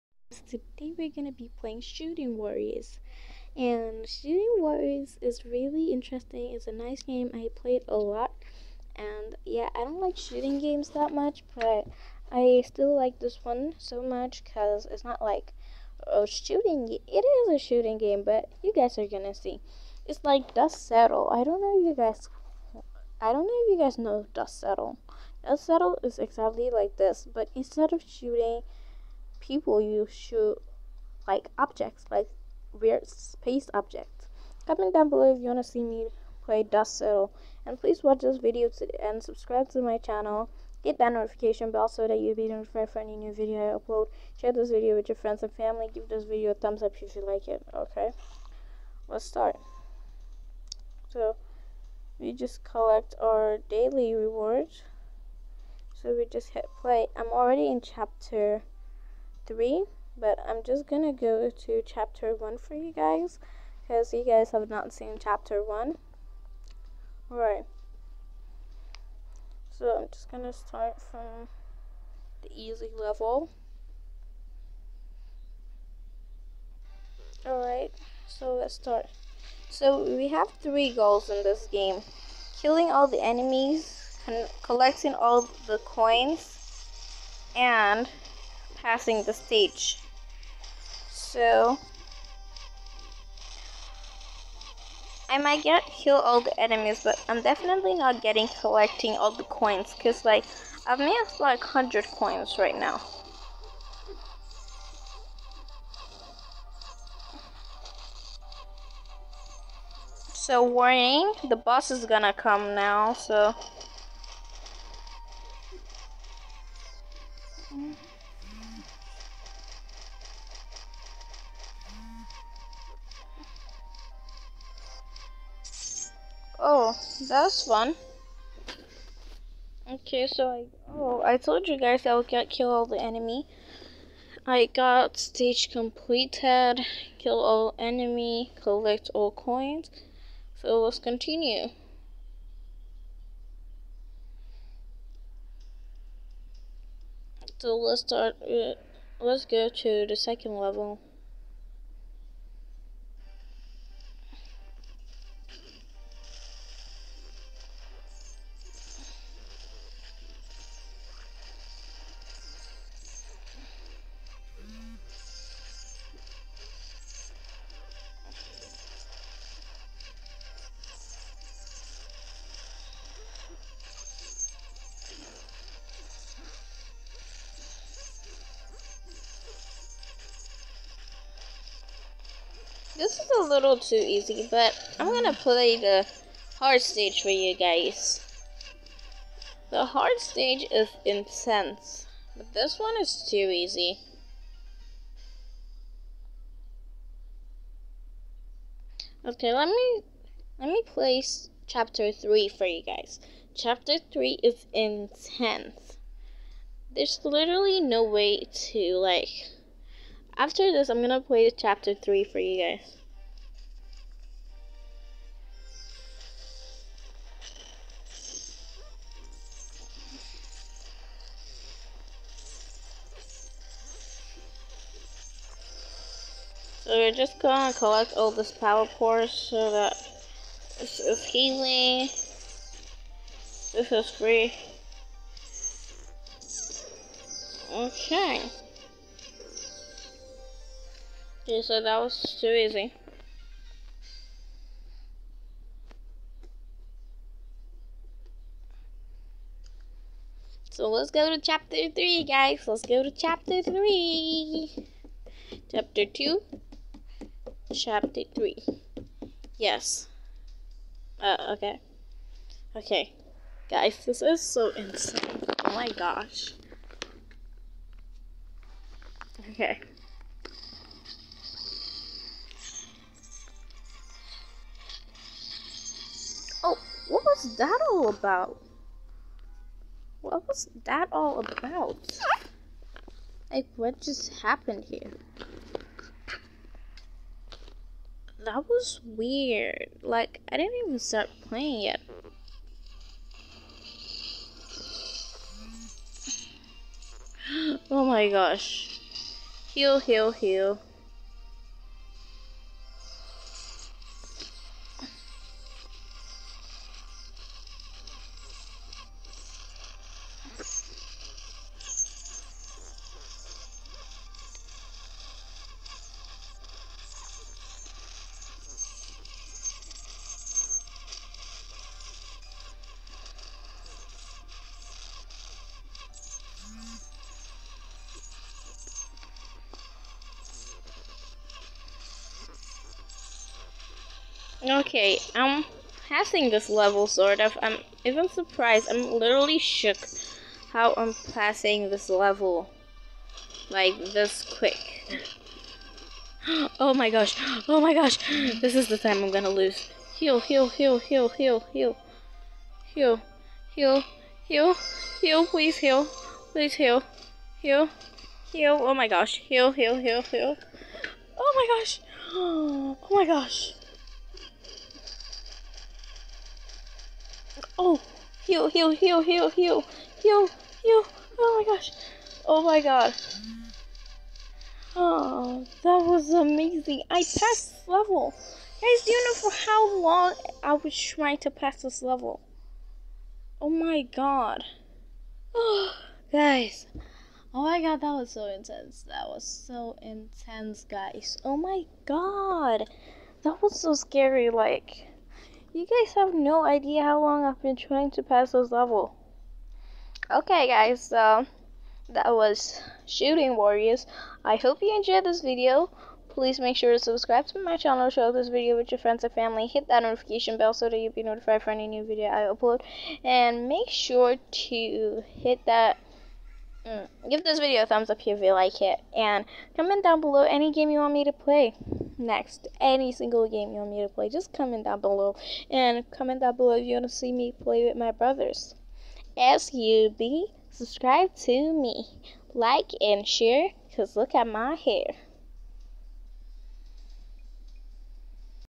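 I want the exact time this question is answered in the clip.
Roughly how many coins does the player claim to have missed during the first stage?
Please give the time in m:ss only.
1:41.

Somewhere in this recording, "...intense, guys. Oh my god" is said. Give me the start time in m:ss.
6:30.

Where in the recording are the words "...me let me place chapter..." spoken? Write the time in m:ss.
3:19.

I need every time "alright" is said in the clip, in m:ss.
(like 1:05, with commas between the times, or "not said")
1:07, 1:17.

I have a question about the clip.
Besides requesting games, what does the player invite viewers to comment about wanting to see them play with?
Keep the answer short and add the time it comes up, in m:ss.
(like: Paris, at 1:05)
brothers, at 7:08.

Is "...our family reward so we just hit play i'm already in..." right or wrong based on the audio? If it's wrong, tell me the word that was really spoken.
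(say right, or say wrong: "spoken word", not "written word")
wrong: "daily", not "family".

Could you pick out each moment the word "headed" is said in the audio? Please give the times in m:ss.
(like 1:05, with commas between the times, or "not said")
not said.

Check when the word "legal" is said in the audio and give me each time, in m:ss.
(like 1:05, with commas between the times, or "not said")
not said.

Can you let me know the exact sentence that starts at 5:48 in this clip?
This is the time I'm gonna lose.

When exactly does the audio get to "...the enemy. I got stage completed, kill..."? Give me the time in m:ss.
2:12.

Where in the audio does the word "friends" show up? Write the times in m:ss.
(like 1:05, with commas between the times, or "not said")
0:45, 6:48.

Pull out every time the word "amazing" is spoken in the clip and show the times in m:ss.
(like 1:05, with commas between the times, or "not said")
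6:16.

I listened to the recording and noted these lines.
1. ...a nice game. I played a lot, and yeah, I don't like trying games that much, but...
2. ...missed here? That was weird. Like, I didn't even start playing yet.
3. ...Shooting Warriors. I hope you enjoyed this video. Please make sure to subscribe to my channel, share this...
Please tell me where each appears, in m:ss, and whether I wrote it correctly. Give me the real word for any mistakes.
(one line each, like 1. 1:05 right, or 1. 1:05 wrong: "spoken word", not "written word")
1. 0:06 wrong: "shooting", not "trying"
2. 4:44 wrong: "happened", not "missed"
3. 6:43 right.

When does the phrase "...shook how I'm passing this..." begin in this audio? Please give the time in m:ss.
5:39.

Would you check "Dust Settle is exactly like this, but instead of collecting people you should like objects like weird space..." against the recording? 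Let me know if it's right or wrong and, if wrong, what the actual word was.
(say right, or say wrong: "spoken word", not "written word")
wrong: "shooting", not "collecting".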